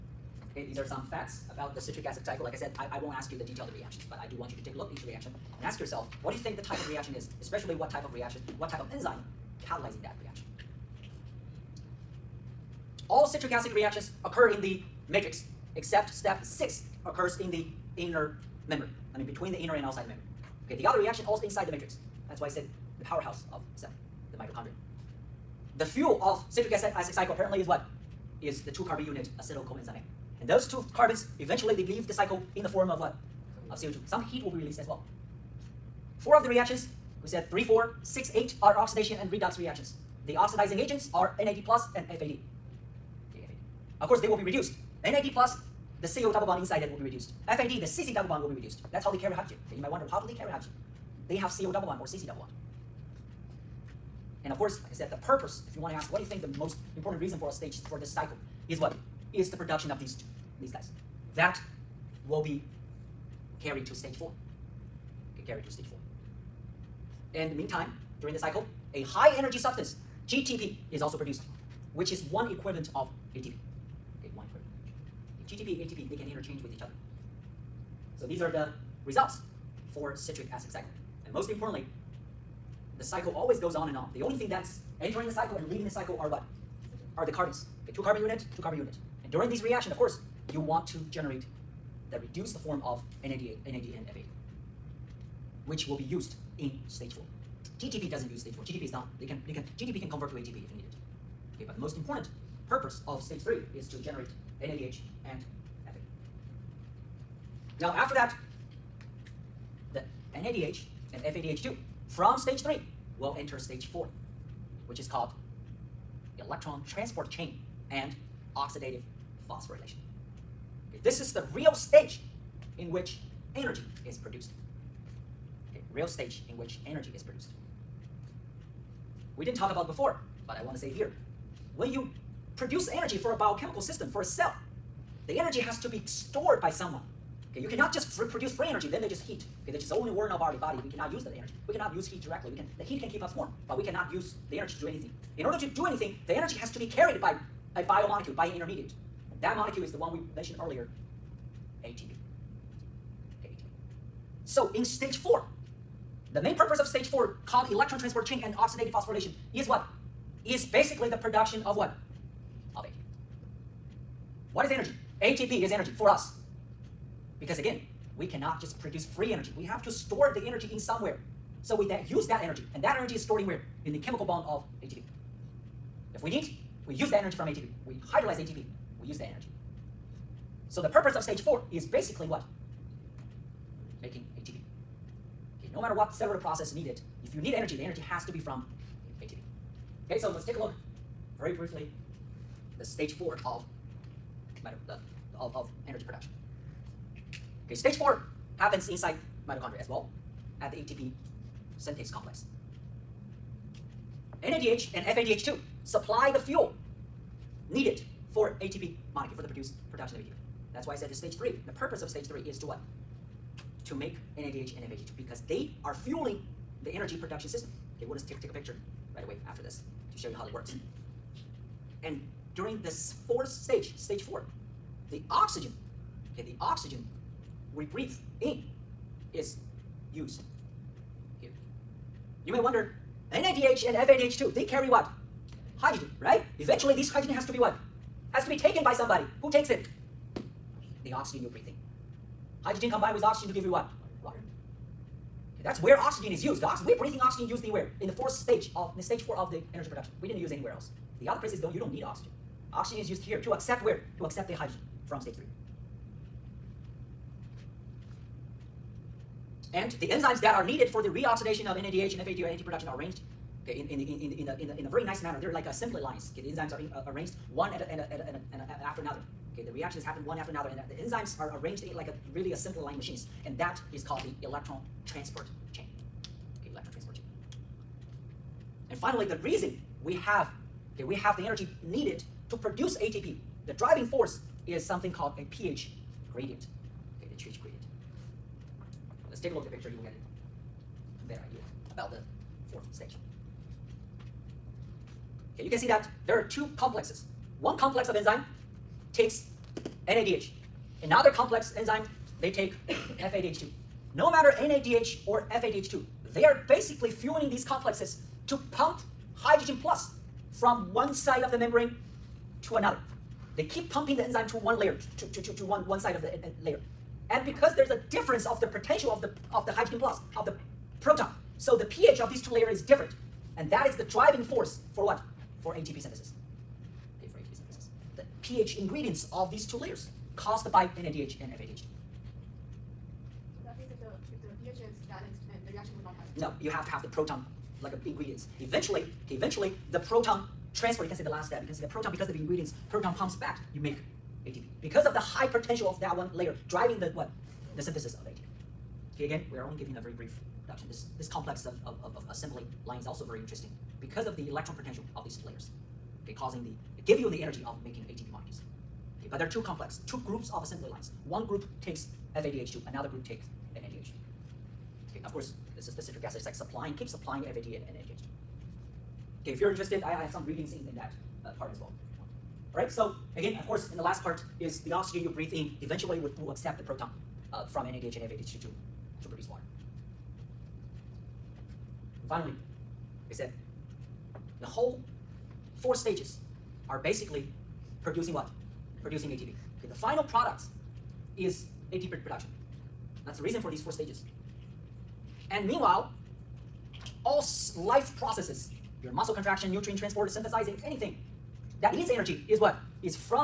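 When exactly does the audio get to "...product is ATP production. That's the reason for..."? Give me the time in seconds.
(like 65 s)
390 s.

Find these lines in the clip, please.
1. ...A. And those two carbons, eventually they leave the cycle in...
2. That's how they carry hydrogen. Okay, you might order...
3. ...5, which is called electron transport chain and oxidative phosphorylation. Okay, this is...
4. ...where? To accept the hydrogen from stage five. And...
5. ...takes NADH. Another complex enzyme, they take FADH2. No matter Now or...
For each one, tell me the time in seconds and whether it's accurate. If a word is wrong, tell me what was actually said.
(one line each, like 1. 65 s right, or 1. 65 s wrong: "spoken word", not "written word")
1. 29 s right
2. 48 s wrong: "wonder", not "order"
3. 113 s wrong: "4", not "5"
4. 253 s wrong: "three", not "five"
5. 299 s wrong: "NADH", not "Now".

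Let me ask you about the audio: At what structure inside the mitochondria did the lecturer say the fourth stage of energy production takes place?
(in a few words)
ATP synthase complex.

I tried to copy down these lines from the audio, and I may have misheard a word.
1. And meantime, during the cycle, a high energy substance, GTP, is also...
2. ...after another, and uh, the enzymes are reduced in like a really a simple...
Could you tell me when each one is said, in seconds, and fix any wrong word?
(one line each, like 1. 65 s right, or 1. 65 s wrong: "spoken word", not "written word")
1. 67 s right
2. 270 s wrong: "arranged", not "reduced".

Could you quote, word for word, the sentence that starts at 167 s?
Because again, we cannot just produce free energy.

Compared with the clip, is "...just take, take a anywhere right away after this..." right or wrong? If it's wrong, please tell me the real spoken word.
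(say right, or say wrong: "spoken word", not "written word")
wrong: "picture", not "anywhere".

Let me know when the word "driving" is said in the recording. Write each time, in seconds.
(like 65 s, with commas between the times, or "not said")
283 s, 324 s, 346 s.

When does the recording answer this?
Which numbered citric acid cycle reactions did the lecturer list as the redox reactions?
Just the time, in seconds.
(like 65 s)
37 s.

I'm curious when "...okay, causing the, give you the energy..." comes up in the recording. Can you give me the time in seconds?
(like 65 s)
356 s.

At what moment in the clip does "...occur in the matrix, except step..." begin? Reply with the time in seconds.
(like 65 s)
14 s.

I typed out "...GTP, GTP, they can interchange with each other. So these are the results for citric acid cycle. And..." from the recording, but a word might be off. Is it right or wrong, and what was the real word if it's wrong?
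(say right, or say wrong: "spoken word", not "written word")
wrong: "ATP", not "GTP".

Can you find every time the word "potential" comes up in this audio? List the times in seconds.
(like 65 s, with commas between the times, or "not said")
318 s, 345 s, 354 s.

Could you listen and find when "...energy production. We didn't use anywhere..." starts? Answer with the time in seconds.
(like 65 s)
249 s.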